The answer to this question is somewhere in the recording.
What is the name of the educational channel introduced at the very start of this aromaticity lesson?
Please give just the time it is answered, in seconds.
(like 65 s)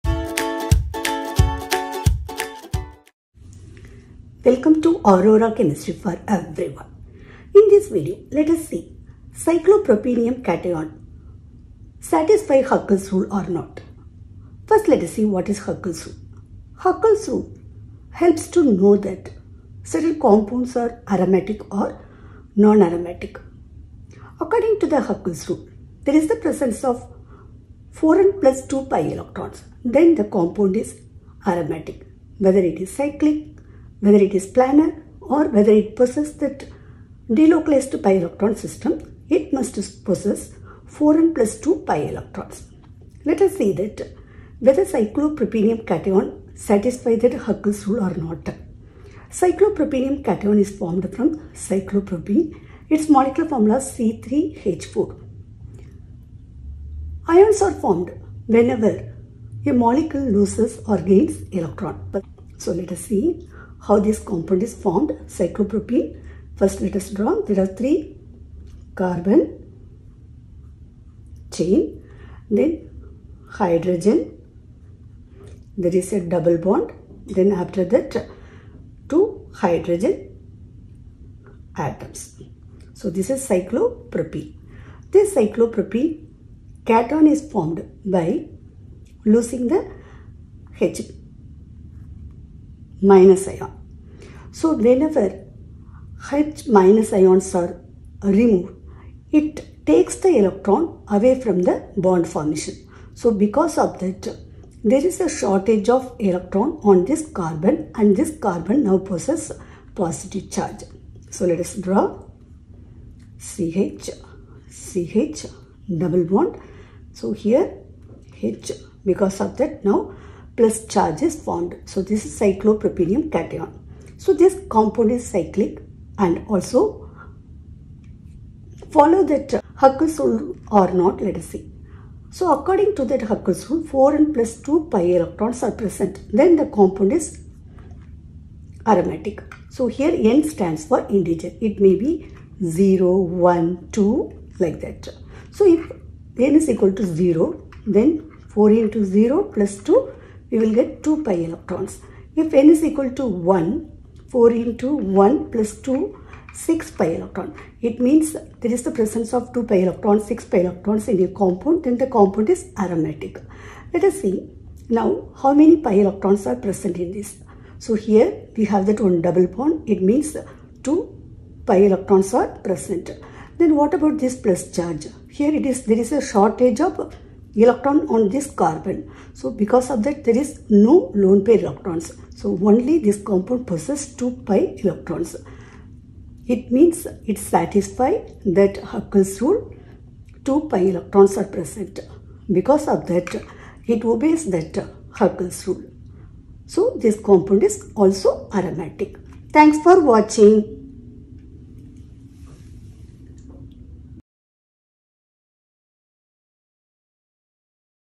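5 s.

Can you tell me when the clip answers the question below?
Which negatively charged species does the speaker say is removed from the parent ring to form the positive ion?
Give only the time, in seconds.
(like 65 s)
90 s.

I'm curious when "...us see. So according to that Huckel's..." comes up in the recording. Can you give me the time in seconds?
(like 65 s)
131 s.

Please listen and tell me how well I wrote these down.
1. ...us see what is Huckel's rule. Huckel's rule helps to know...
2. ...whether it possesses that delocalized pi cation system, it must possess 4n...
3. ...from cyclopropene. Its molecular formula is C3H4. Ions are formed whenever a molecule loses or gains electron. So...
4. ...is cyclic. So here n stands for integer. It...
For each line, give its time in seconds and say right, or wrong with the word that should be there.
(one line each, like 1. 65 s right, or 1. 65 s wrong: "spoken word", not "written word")
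1. 15 s right
2. 35 s wrong: "electron", not "cation"
3. 51 s right
4. 137 s wrong: "aromatic", not "cyclic".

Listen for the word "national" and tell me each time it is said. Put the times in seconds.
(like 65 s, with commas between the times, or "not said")
not said.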